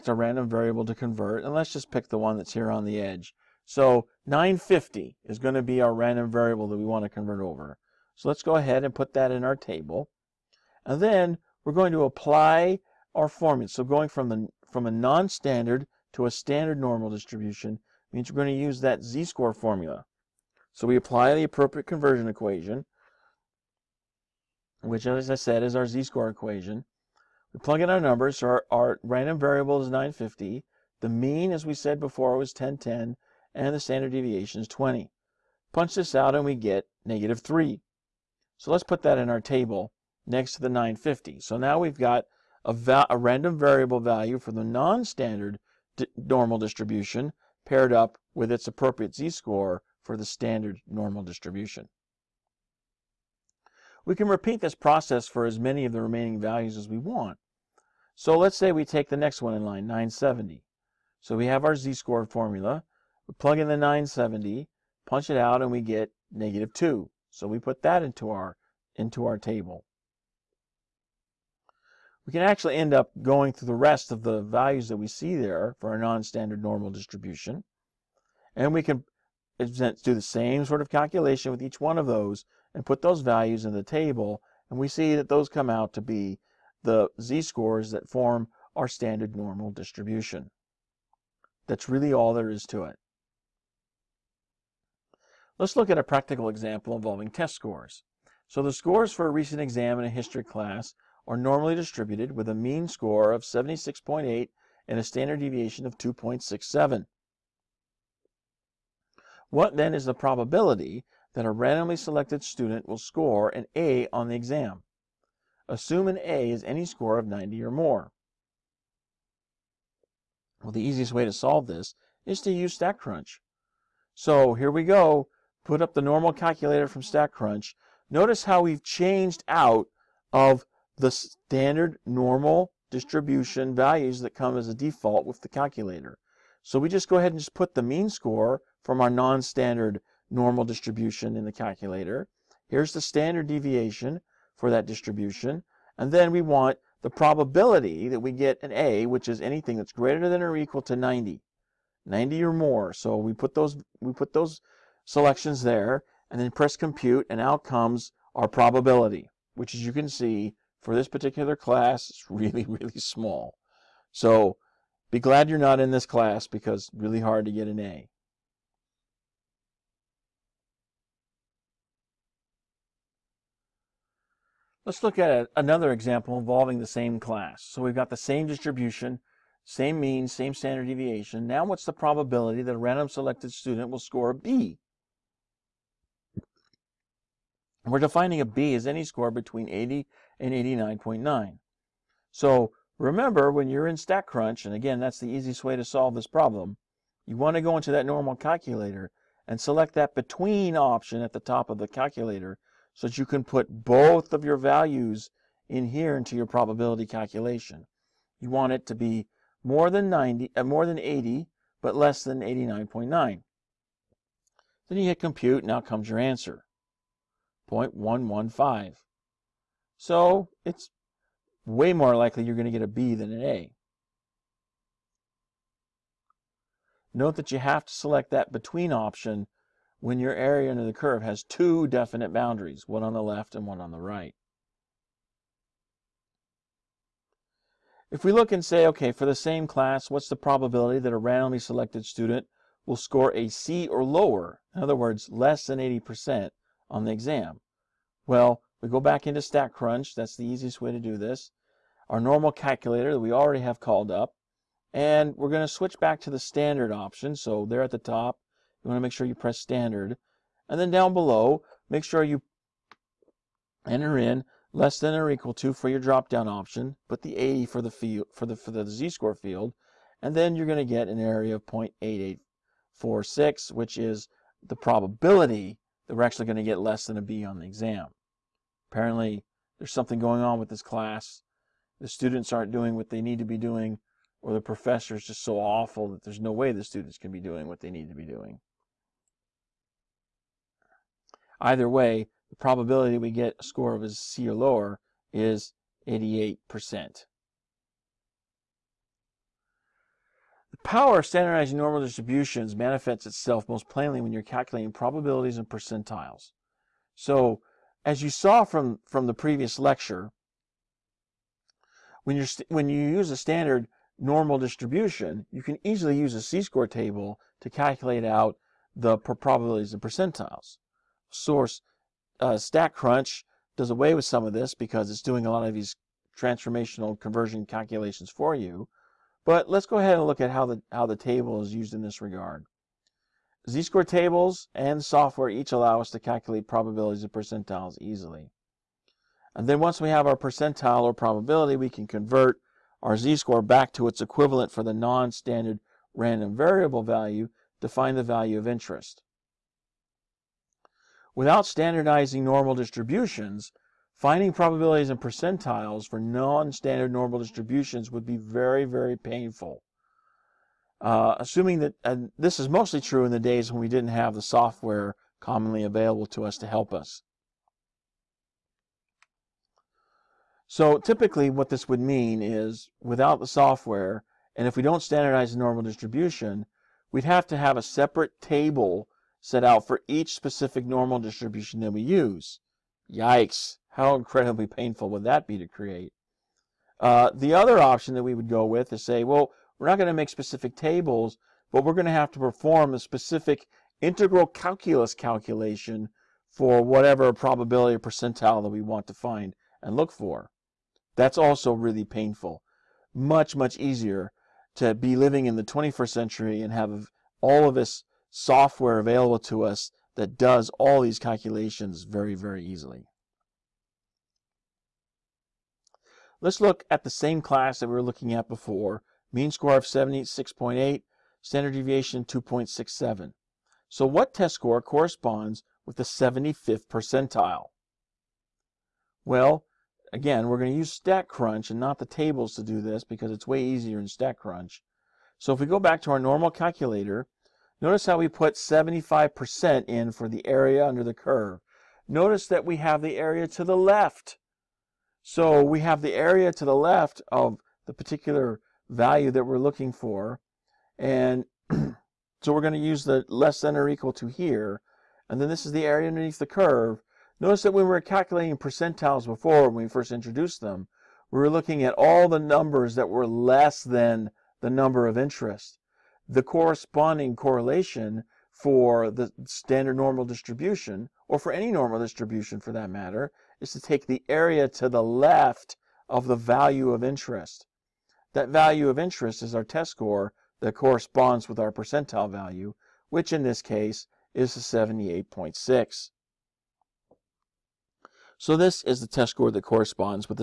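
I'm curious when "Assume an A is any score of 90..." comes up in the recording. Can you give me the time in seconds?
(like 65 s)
115 s.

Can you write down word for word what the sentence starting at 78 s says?
And we can do the same sort of calculation with each one of those and put those values in the table.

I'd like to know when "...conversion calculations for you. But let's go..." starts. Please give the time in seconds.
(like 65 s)
327 s.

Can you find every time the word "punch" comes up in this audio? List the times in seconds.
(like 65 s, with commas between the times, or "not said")
35 s, 65 s.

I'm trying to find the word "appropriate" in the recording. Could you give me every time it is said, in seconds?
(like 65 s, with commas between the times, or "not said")
21 s, 48 s.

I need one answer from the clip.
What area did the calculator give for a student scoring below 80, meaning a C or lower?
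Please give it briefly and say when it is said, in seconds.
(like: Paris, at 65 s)
0.8846, at 271 s.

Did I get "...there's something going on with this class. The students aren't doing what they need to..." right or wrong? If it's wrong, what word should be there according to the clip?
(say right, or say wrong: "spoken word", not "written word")
right.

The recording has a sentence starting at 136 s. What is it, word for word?
So we just go ahead and just put the mean score from our non-standard normal distribution in the calculator.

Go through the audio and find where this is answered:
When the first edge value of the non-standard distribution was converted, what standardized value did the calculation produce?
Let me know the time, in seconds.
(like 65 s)
37 s.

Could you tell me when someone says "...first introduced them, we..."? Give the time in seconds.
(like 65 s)
459 s.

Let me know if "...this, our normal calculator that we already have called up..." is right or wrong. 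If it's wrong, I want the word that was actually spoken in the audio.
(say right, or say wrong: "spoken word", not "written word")
right.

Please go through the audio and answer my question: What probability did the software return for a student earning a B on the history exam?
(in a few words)
0.115.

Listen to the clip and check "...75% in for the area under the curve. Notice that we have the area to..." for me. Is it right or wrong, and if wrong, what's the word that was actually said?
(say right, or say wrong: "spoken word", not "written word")
right.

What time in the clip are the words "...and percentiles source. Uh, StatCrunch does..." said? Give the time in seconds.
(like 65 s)
319 s.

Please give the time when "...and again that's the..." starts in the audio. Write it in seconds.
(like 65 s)
194 s.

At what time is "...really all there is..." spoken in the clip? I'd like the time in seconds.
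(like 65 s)
91 s.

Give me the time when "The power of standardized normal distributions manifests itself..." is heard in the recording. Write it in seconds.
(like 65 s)
300 s.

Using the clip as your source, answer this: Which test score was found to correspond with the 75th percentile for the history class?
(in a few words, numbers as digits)
78.6.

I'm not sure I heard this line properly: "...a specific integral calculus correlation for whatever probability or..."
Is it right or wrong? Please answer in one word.
wrong.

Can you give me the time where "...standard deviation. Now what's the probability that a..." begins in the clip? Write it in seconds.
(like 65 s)
180 s.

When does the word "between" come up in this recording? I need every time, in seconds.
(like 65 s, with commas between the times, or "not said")
189 s, 200 s, 228 s.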